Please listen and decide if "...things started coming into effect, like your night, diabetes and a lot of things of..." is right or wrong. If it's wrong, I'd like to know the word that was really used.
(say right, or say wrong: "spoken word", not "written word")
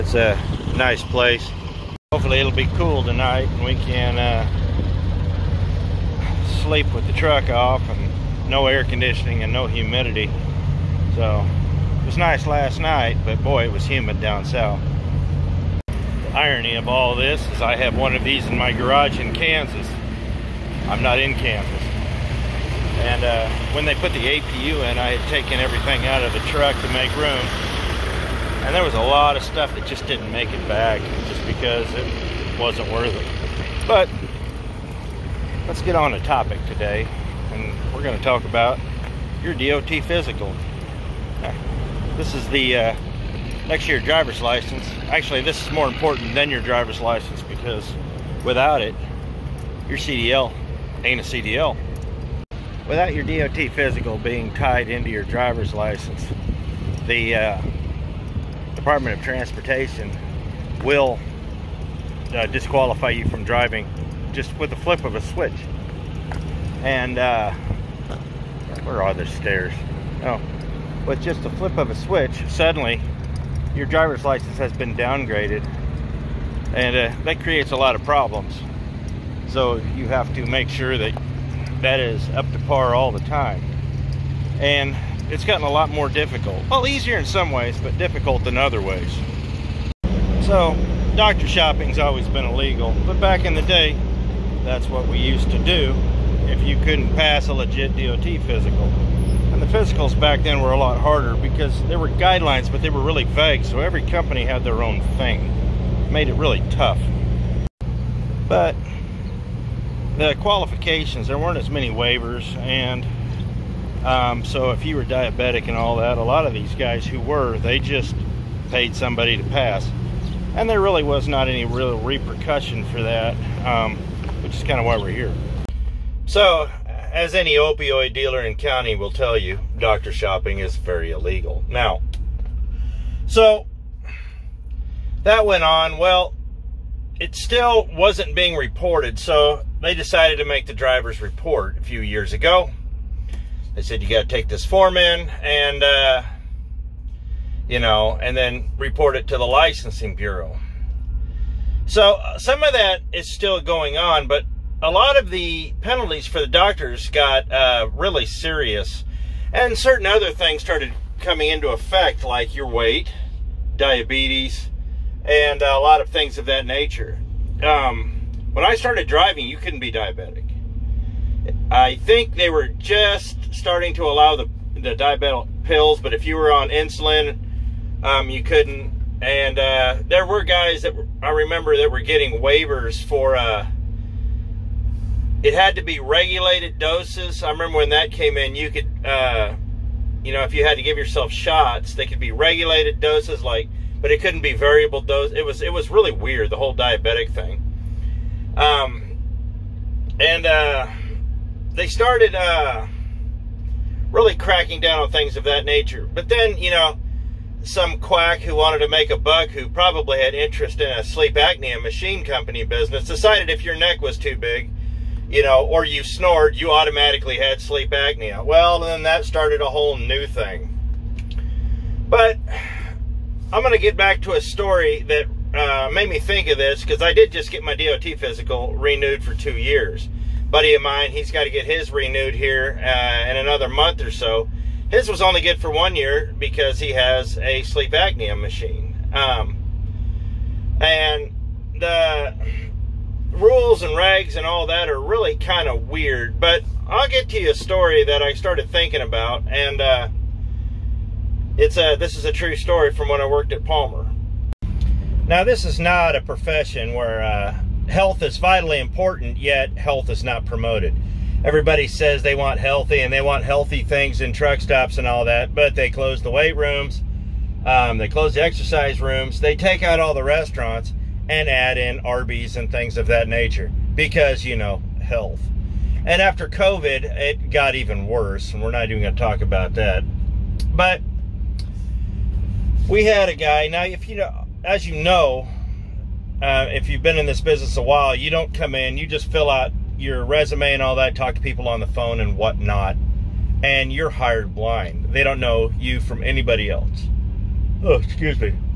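wrong: "weight", not "night".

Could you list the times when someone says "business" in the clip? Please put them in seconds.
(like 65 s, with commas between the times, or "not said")
212 s, 287 s.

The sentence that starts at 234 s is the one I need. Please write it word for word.
His was only good for one year because he has a sleep apnea machine.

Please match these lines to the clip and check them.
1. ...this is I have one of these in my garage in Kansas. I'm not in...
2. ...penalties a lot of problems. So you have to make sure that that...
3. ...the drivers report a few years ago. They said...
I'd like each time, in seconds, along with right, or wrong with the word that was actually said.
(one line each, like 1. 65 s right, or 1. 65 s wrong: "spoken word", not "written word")
1. 17 s right
2. 77 s wrong: "creates", not "penalties"
3. 140 s right.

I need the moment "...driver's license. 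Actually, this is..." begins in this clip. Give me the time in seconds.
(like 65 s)
44 s.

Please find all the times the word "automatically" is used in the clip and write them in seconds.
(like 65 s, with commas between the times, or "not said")
216 s.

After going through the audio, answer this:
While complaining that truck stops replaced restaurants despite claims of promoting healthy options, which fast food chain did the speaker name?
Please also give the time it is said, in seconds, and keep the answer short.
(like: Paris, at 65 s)
Arby's, at 272 s.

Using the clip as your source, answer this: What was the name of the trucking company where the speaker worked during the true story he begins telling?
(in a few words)
Palmer.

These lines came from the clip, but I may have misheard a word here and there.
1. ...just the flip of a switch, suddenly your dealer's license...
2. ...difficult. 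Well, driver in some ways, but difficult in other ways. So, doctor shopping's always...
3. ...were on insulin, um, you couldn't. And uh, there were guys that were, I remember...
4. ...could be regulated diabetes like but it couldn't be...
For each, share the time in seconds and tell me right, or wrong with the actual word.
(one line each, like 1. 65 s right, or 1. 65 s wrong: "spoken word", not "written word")
1. 71 s wrong: "driver", not "dealer"
2. 86 s wrong: "easier", not "driver"
3. 176 s right
4. 192 s wrong: "doses", not "diabetes".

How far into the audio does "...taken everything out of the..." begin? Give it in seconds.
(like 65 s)
25 s.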